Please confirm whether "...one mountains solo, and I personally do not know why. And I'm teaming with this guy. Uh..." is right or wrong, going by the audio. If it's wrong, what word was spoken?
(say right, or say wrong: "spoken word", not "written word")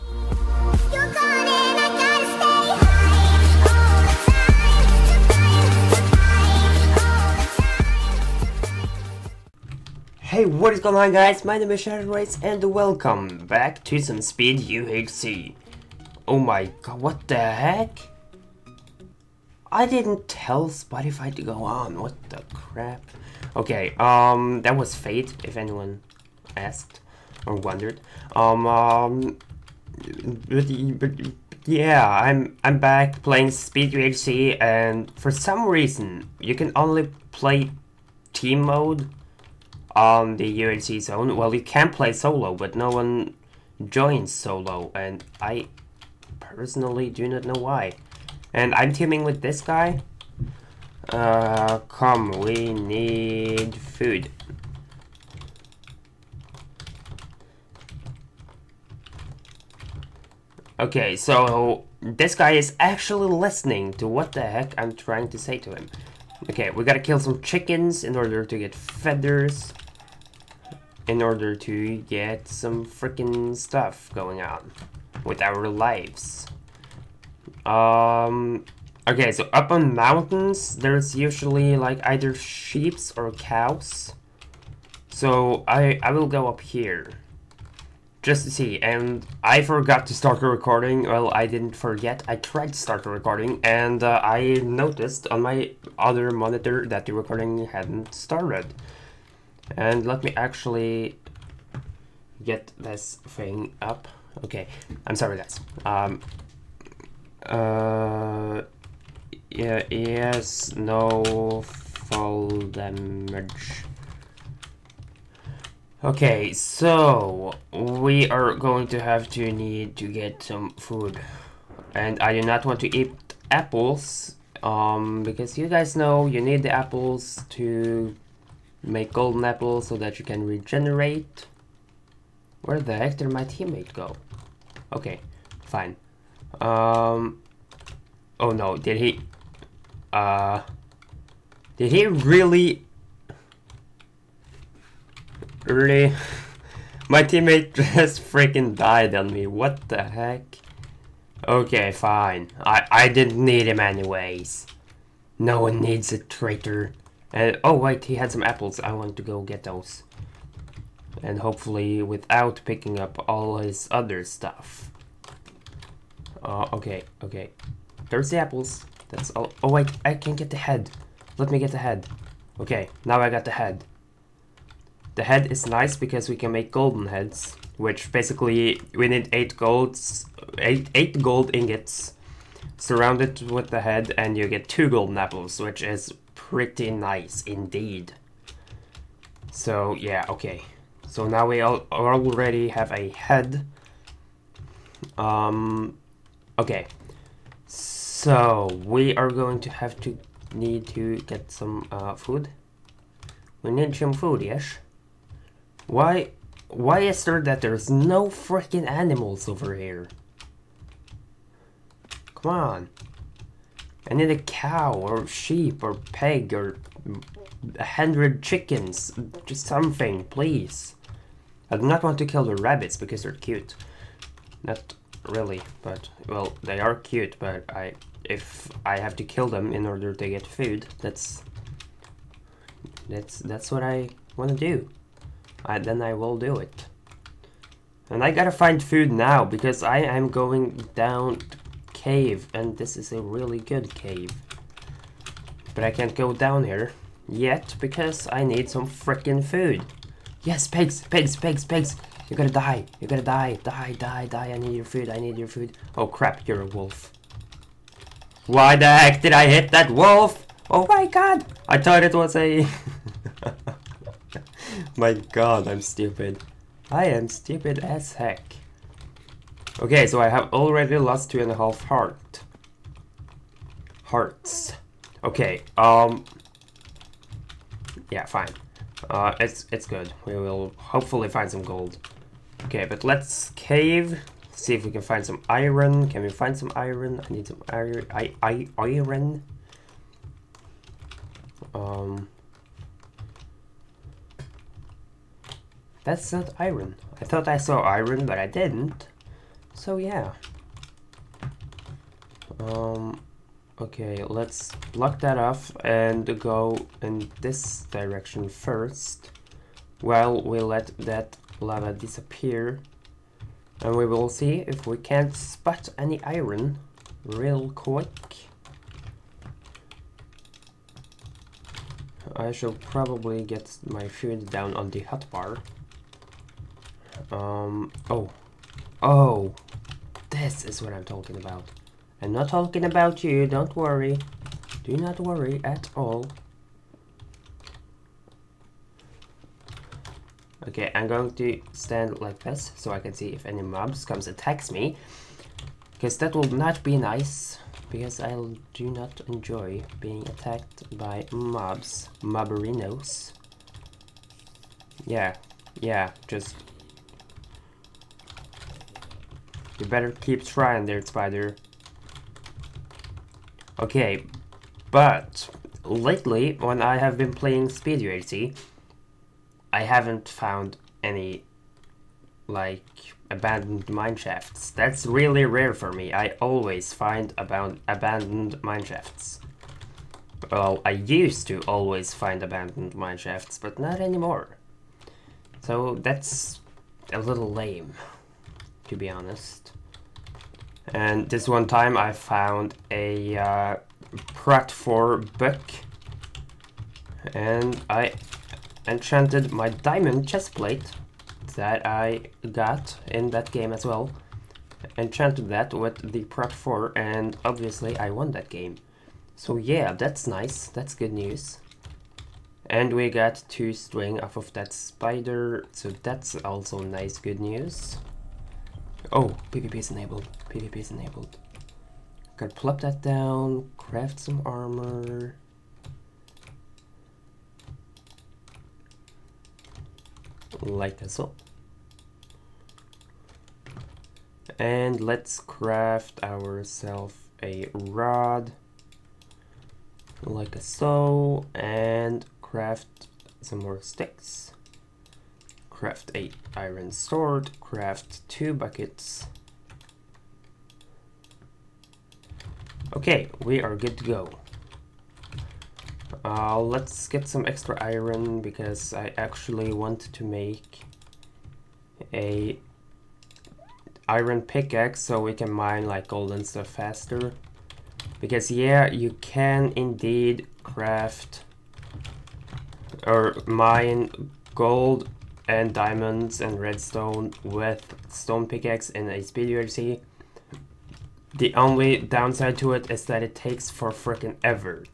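wrong: "joins", not "mountains".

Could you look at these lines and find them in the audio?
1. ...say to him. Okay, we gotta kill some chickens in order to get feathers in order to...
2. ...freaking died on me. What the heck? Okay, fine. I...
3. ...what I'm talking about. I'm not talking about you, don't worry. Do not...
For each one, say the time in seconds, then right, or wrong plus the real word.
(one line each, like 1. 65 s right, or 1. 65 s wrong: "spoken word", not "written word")
1. 65 s right
2. 148 s right
3. 330 s right.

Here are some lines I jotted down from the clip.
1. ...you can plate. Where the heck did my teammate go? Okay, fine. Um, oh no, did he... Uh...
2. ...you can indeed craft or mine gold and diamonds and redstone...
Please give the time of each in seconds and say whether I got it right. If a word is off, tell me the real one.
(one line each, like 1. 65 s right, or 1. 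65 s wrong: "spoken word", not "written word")
1. 130 s wrong: "regenerate", not "plate"
2. 468 s right.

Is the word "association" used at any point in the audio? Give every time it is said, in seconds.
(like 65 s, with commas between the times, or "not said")
not said.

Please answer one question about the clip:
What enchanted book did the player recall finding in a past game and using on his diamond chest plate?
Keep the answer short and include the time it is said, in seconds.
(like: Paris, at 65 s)
Prot 4, at 394 s.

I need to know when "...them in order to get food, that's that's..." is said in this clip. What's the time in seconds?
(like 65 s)
229 s.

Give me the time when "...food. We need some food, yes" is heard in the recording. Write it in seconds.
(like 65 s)
202 s.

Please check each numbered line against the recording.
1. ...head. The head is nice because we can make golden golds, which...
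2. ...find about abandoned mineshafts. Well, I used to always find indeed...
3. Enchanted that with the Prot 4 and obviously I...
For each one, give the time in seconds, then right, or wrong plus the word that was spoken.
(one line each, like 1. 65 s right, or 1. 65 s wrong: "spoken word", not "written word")
1. 173 s wrong: "heads", not "golds"
2. 376 s wrong: "abandoned", not "indeed"
3. 404 s right.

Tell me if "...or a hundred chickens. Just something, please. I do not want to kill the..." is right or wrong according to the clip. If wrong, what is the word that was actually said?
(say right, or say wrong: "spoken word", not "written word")
right.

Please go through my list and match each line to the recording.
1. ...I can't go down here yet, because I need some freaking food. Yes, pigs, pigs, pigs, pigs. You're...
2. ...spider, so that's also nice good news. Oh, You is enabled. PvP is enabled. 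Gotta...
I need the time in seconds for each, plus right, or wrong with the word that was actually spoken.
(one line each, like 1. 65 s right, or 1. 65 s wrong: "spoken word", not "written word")
1. 245 s right
2. 414 s wrong: "PvP", not "You".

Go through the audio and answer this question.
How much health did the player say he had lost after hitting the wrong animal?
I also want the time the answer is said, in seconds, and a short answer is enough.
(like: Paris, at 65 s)
2.5 hearts, at 271 s.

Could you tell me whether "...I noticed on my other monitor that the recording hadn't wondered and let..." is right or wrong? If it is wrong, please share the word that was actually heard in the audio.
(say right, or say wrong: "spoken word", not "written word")
wrong: "started", not "wondered".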